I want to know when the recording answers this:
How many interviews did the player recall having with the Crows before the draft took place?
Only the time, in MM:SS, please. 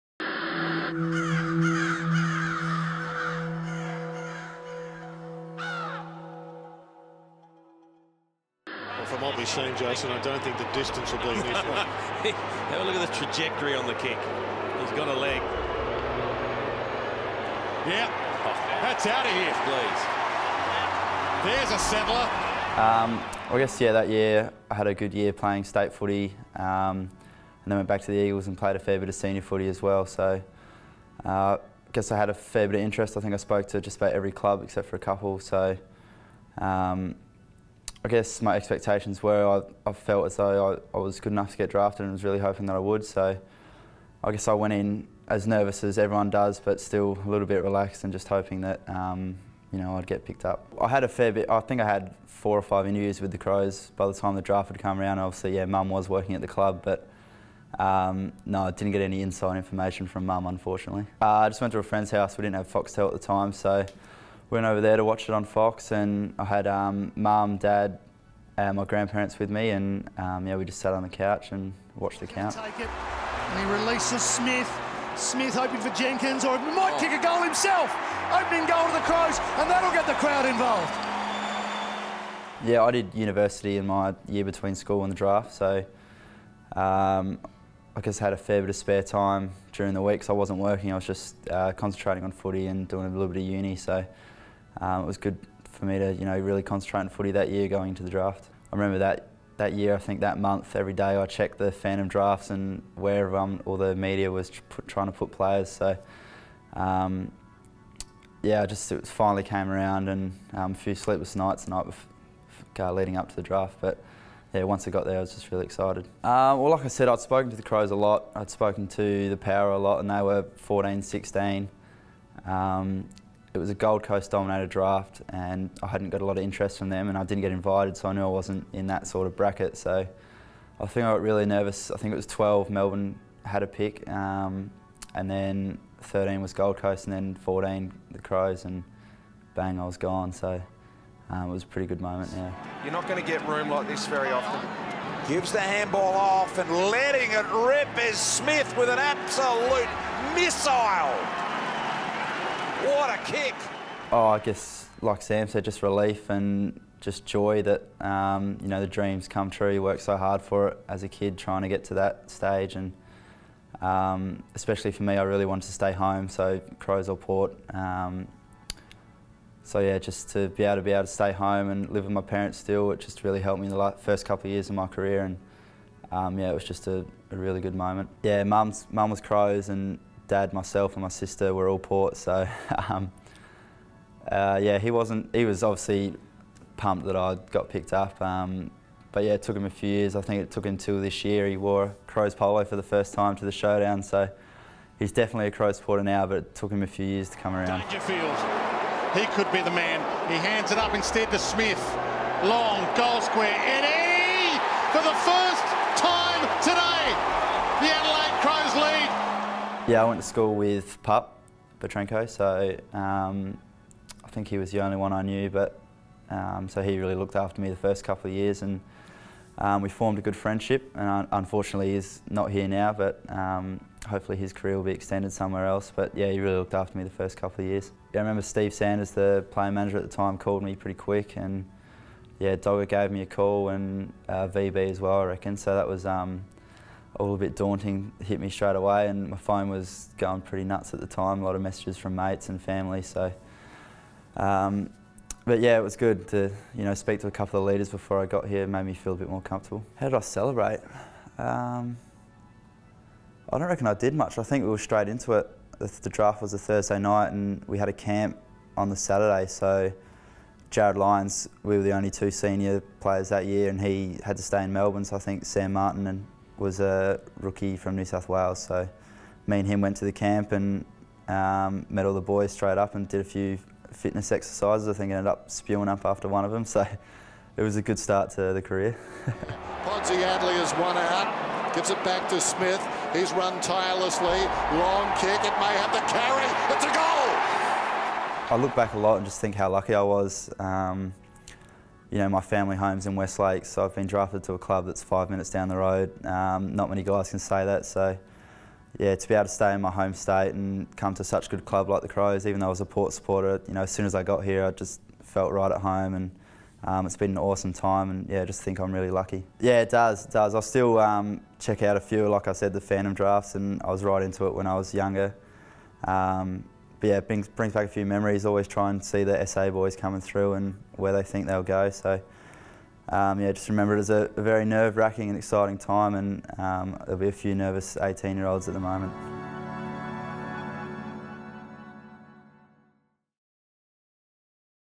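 00:52.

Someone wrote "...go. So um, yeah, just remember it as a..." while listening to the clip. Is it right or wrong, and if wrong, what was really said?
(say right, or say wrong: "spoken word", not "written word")
right.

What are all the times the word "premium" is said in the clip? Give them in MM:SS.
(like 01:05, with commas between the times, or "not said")
not said.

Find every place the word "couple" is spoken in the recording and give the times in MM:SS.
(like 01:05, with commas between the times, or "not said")
00:34, 02:54, 03:38, 03:47, 04:07.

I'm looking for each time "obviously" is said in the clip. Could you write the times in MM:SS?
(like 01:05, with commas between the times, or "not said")
00:55, 03:05.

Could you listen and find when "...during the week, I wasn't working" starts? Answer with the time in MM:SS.
01:29.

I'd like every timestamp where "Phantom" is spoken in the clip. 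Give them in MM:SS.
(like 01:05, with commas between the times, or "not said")
01:41, 05:12.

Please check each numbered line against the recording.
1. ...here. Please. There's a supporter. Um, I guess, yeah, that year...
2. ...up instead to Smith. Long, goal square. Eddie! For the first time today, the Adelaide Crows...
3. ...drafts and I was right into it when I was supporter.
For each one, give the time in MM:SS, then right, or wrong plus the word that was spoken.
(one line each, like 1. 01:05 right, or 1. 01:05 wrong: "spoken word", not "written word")
1. 00:19 wrong: "settler", not "supporter"
2. 03:20 right
3. 05:13 wrong: "younger", not "supporter".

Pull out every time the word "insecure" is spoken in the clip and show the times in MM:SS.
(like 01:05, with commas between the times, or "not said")
not said.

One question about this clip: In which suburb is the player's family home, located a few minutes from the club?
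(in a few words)
Westlake.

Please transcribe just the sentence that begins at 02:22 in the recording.
You're not going to get room like this very often.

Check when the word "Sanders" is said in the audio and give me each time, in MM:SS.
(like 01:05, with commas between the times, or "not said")
03:48.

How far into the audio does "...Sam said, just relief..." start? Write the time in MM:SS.
02:35.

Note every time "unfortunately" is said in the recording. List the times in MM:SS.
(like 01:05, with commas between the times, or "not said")
01:00, 03:41.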